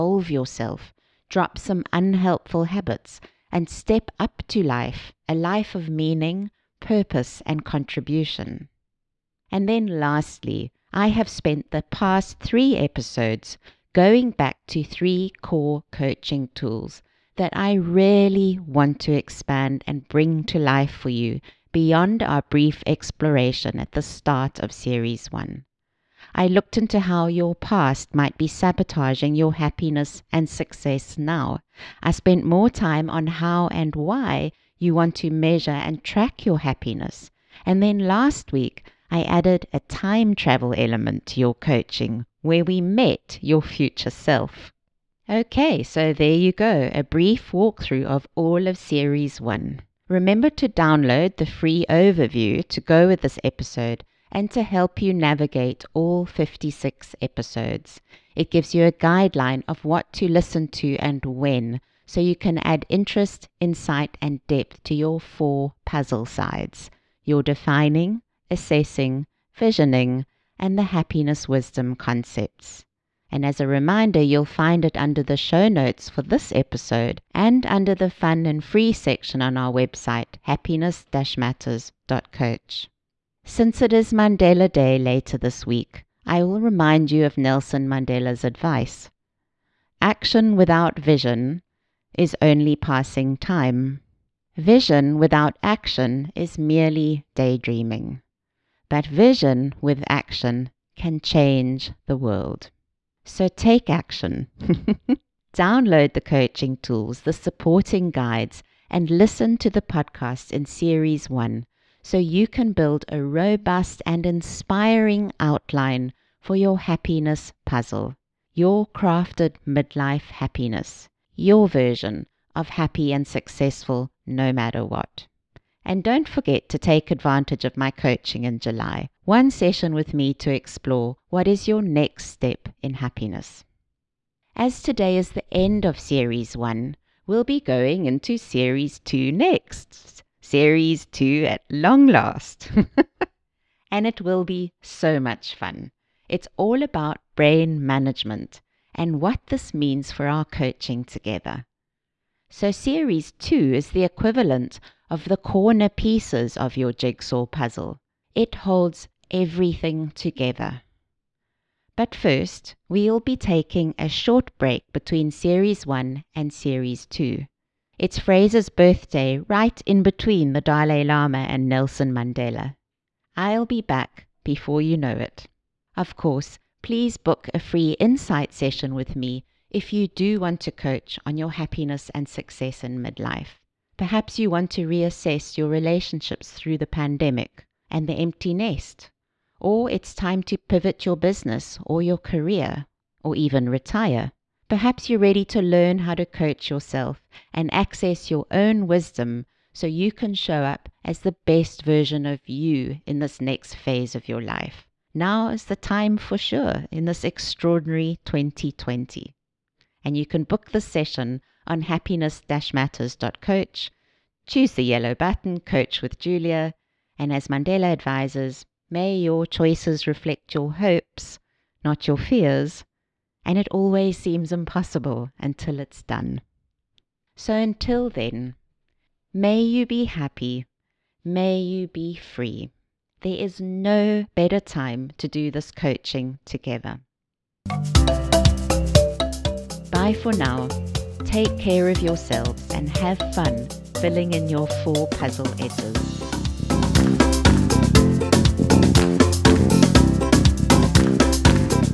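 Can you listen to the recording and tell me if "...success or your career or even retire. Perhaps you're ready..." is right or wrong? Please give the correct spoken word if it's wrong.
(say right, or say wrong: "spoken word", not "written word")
wrong: "business", not "success".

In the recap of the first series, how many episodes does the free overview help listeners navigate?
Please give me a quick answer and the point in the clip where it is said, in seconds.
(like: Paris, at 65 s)
56, at 56 s.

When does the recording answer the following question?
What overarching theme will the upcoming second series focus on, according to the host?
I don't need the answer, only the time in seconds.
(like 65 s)
147 s.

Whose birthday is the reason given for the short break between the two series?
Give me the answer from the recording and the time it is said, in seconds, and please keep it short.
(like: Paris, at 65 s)
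Fraser, at 168 s.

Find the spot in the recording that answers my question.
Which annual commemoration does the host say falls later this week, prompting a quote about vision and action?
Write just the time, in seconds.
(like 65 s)
84 s.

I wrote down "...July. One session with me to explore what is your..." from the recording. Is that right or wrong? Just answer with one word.
right.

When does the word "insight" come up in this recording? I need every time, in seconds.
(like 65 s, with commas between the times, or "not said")
63 s, 177 s.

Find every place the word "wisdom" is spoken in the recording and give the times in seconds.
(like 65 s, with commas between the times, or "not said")
71 s, 198 s.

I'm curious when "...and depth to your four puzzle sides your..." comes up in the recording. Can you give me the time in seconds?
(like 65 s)
64 s.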